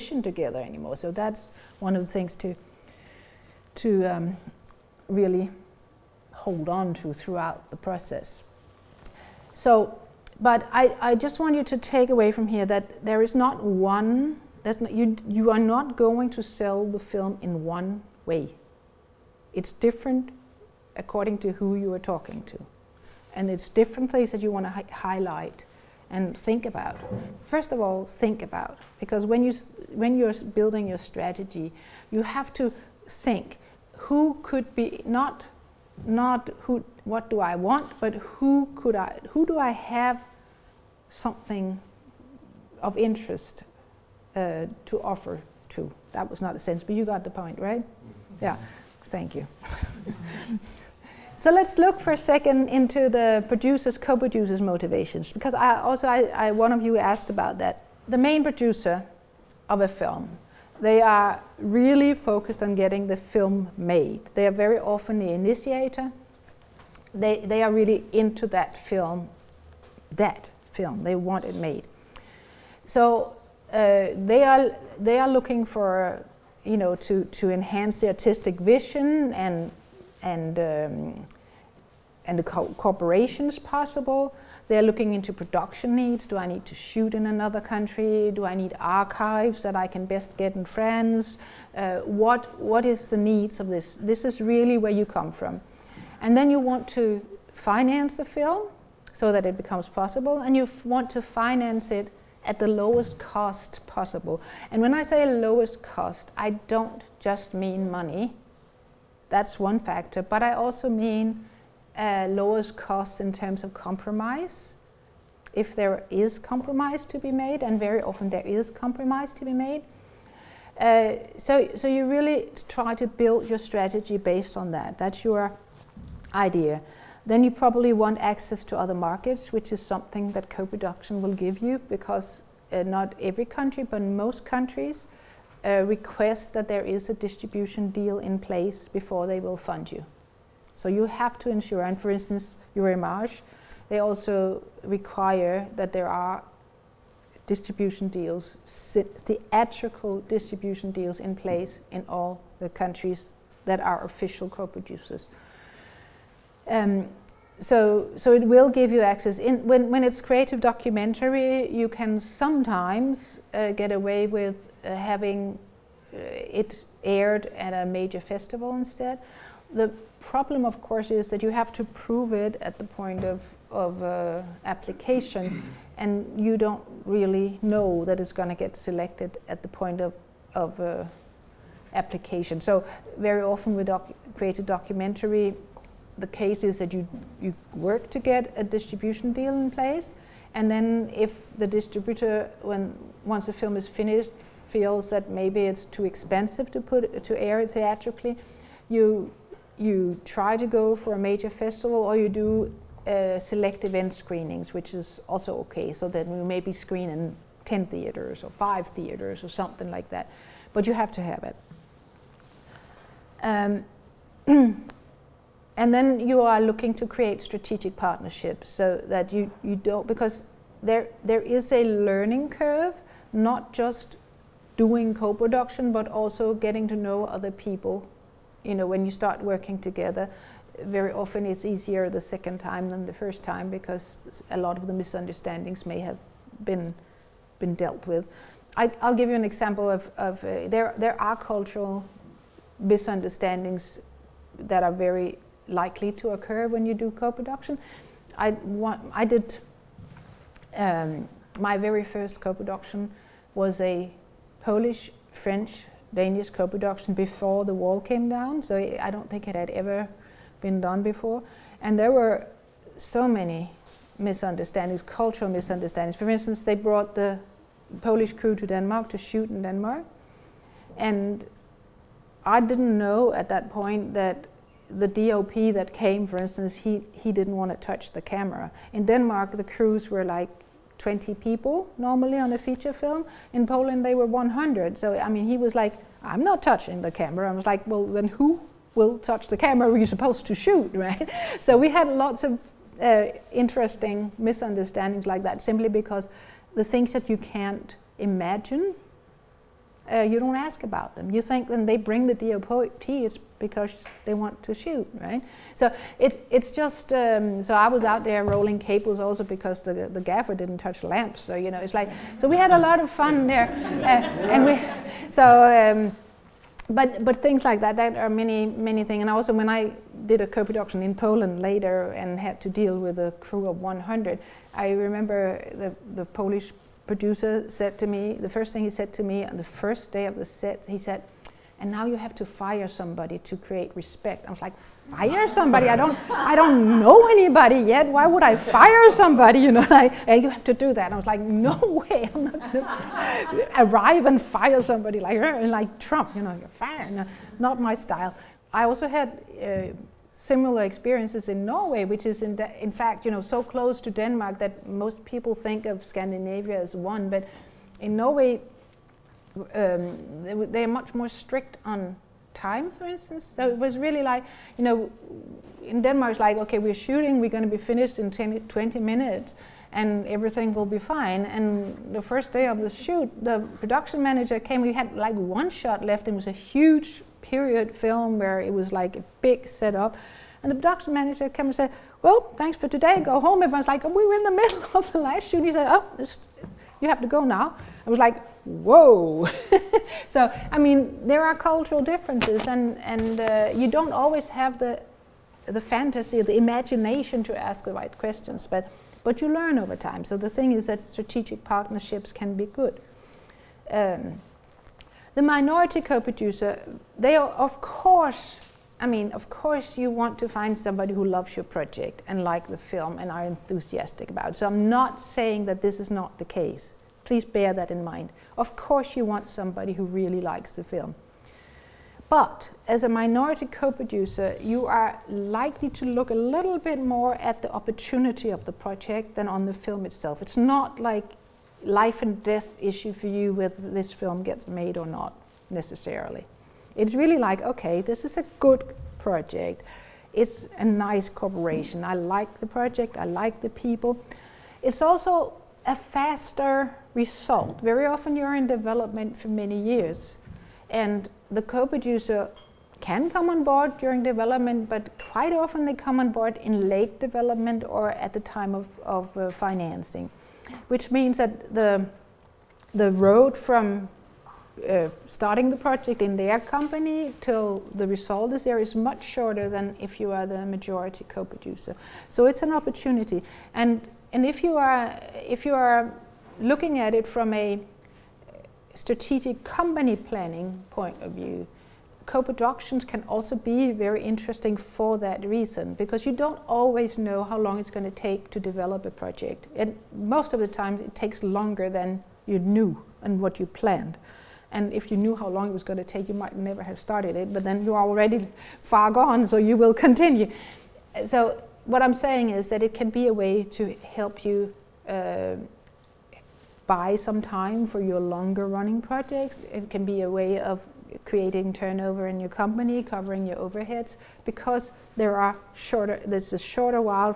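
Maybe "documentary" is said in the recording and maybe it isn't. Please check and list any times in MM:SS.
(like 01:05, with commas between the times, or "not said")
02:40, 03:04.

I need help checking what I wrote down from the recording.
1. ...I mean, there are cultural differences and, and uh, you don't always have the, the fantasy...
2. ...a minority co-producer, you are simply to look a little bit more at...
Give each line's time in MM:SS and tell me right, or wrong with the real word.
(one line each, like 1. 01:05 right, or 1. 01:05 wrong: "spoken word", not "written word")
1. 06:30 right
2. 07:03 wrong: "likely", not "simply".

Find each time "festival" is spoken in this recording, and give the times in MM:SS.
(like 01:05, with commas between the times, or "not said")
02:48, 03:21.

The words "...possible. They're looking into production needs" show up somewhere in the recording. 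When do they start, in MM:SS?
01:23.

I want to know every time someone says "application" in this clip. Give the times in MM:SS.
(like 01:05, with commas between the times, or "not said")
02:54, 03:01.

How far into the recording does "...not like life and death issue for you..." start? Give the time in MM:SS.
07:10.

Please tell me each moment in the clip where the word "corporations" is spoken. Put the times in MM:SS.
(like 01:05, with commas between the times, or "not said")
01:22, 07:21.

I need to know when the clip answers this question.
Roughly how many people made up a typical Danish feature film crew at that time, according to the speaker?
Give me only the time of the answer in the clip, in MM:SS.
04:40.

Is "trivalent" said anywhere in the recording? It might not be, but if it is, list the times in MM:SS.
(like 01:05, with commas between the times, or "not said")
not said.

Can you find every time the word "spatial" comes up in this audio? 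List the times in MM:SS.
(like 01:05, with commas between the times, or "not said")
not said.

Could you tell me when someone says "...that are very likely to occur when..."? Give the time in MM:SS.
04:04.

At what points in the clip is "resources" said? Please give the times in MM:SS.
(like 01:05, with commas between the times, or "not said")
not said.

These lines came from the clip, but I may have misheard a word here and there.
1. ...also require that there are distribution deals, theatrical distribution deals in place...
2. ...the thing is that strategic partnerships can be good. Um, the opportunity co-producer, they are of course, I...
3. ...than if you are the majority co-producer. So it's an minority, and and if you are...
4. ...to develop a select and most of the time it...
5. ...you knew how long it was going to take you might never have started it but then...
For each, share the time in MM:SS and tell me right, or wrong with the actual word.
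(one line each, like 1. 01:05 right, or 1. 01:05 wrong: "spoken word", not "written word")
1. 02:23 right
2. 06:40 wrong: "minority", not "opportunity"
3. 07:49 wrong: "opportunity", not "minority"
4. 08:08 wrong: "project", not "select"
5. 08:15 right.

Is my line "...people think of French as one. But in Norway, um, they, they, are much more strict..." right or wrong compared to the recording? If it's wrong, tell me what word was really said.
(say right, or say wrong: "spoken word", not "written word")
wrong: "Scandinavia", not "French".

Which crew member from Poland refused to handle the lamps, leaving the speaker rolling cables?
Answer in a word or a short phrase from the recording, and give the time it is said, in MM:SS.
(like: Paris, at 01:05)
the gaffer, at 05:10.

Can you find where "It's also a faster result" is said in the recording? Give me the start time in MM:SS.
07:24.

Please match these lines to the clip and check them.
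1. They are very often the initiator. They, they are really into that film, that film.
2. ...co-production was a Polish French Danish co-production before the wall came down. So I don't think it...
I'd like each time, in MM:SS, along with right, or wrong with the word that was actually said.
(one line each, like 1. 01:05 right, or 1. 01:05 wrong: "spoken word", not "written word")
1. 01:04 right
2. 04:12 right.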